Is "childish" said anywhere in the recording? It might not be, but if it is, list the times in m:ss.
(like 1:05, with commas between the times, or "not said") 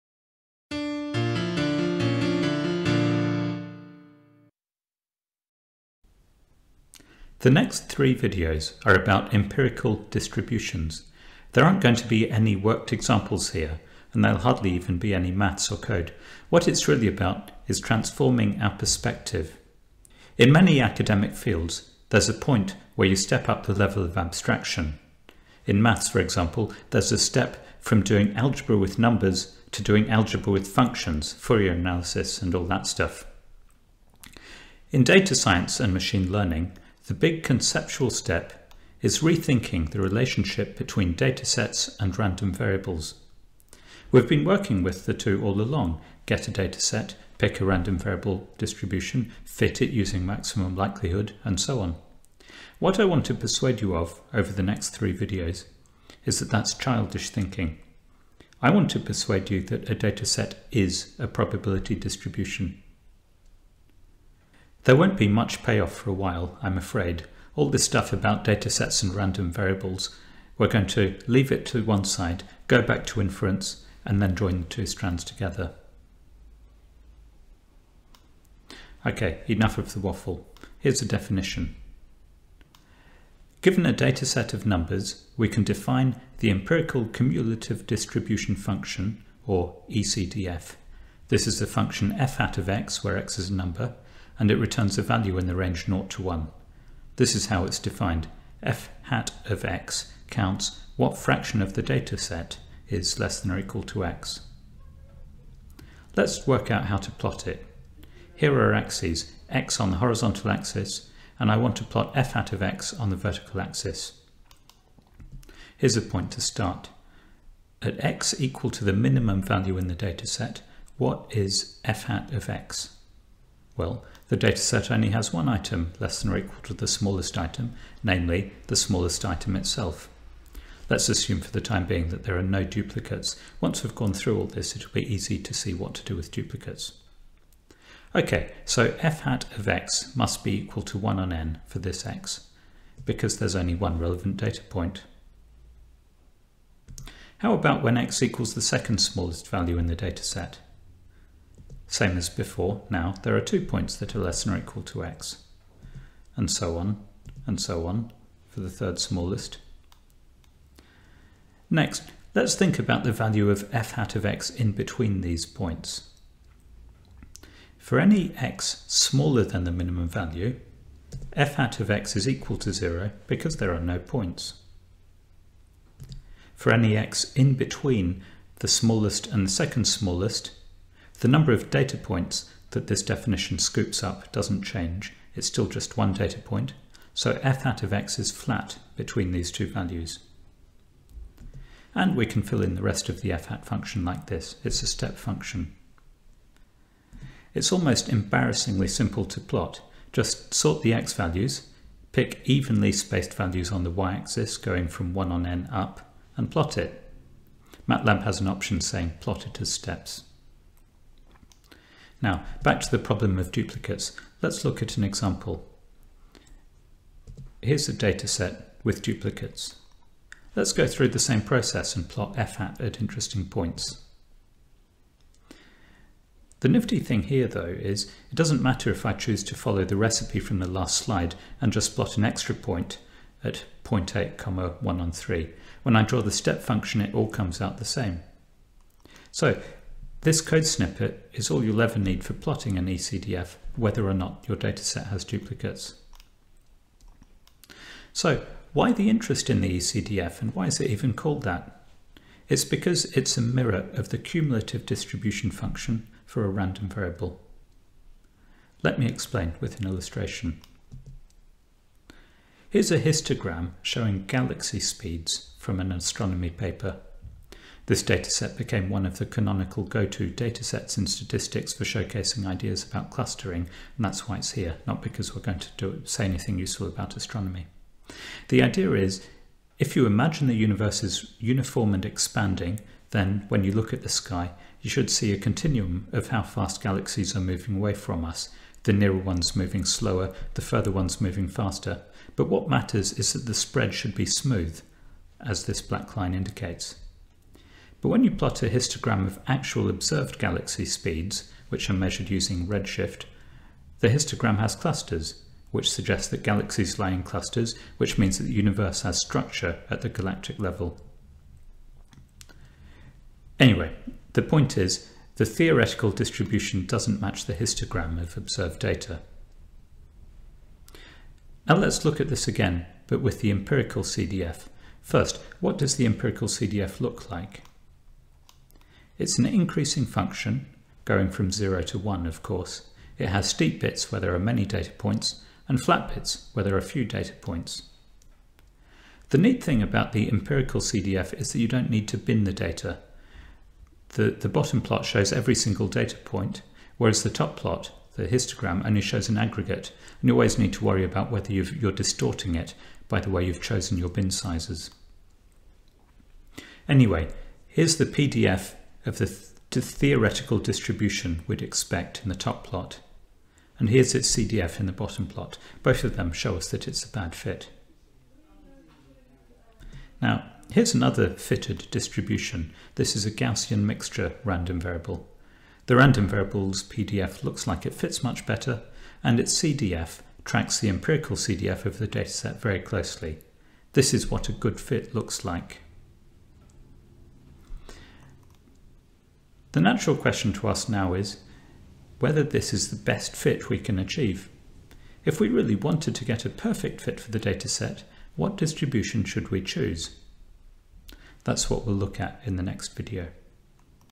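0:56.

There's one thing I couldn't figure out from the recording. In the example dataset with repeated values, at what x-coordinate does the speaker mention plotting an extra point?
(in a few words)
0.8.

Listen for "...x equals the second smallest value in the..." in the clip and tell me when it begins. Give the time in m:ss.
2:27.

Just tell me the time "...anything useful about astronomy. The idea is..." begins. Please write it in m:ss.
4:36.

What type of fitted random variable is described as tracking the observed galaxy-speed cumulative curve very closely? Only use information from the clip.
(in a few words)
Gaussian mixture.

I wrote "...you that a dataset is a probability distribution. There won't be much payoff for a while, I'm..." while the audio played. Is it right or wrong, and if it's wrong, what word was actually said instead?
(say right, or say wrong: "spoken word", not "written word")
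right.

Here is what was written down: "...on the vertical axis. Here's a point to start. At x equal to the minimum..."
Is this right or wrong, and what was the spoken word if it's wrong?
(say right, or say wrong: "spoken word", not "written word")
right.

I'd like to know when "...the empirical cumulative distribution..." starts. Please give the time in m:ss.
1:26.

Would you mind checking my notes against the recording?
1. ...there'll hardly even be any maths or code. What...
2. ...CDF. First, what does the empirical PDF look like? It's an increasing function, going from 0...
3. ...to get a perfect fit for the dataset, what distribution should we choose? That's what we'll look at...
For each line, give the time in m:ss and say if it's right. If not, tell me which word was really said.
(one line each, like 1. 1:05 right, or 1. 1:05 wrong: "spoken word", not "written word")
1. 0:14 right
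2. 5:24 wrong: "CDF", not "PDF"
3. 6:36 right.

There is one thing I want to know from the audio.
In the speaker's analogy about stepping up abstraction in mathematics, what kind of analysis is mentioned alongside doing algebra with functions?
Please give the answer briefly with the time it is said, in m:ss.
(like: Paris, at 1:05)
Fourier analysis, at 0:31.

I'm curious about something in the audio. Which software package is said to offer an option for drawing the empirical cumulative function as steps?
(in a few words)
MATLAB.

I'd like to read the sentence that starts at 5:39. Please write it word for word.
The neat thing about the empirical CDF is that you don't need to bin the data.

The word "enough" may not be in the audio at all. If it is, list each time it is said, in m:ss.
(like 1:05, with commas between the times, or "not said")
1:19.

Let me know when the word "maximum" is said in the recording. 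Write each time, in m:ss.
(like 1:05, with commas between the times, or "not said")
0:50.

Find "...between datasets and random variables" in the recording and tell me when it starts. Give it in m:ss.
0:40.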